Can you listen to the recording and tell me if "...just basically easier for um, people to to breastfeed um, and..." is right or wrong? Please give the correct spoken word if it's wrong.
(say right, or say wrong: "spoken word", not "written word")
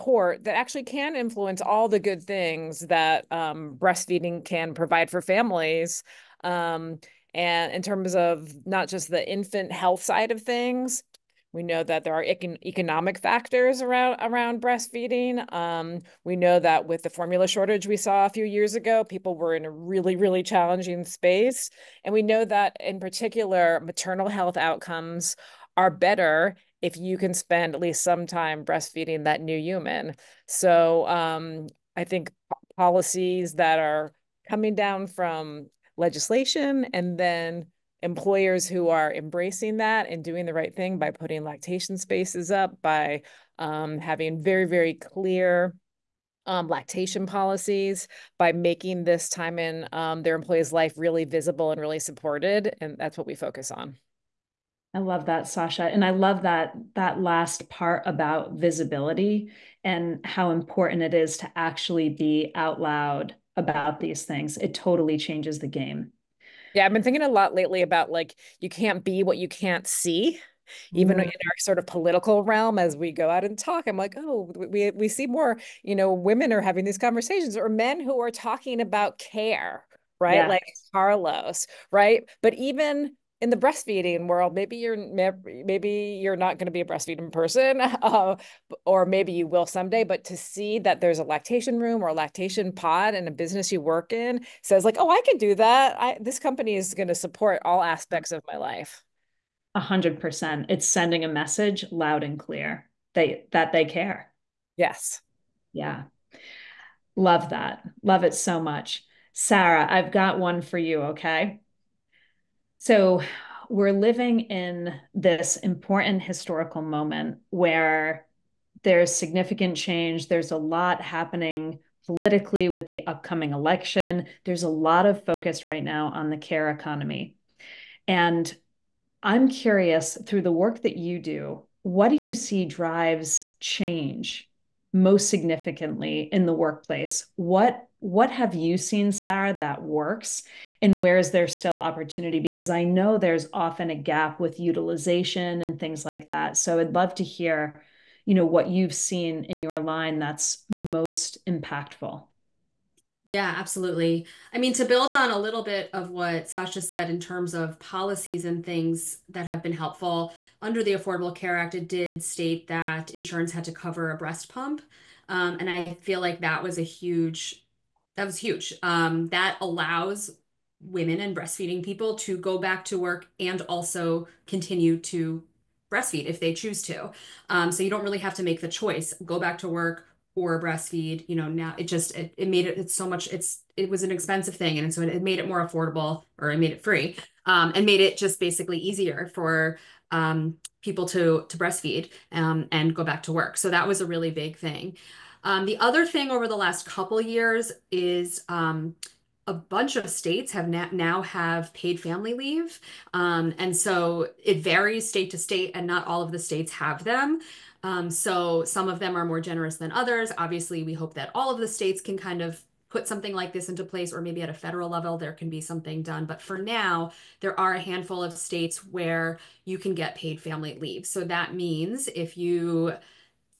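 right.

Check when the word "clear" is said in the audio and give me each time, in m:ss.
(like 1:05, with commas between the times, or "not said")
0:44, 1:42.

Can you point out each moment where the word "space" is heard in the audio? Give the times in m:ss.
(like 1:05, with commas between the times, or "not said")
0:21, 0:41.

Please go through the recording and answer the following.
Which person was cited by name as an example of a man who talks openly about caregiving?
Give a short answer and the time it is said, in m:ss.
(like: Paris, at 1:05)
Carlos, at 1:20.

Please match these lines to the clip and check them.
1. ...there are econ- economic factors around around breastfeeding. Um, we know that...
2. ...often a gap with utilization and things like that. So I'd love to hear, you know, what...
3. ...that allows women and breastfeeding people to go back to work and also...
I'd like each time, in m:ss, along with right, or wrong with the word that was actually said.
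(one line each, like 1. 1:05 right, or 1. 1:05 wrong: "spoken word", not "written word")
1. 0:12 right
2. 2:23 right
3. 2:49 right.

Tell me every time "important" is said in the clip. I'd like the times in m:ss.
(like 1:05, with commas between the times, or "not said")
1:00, 1:55.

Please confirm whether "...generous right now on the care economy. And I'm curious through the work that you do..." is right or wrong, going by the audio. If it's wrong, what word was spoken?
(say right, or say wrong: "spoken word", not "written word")
wrong: "focus", not "generous".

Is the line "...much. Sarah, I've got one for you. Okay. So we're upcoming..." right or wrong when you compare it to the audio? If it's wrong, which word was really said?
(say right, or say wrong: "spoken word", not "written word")
wrong: "living", not "upcoming".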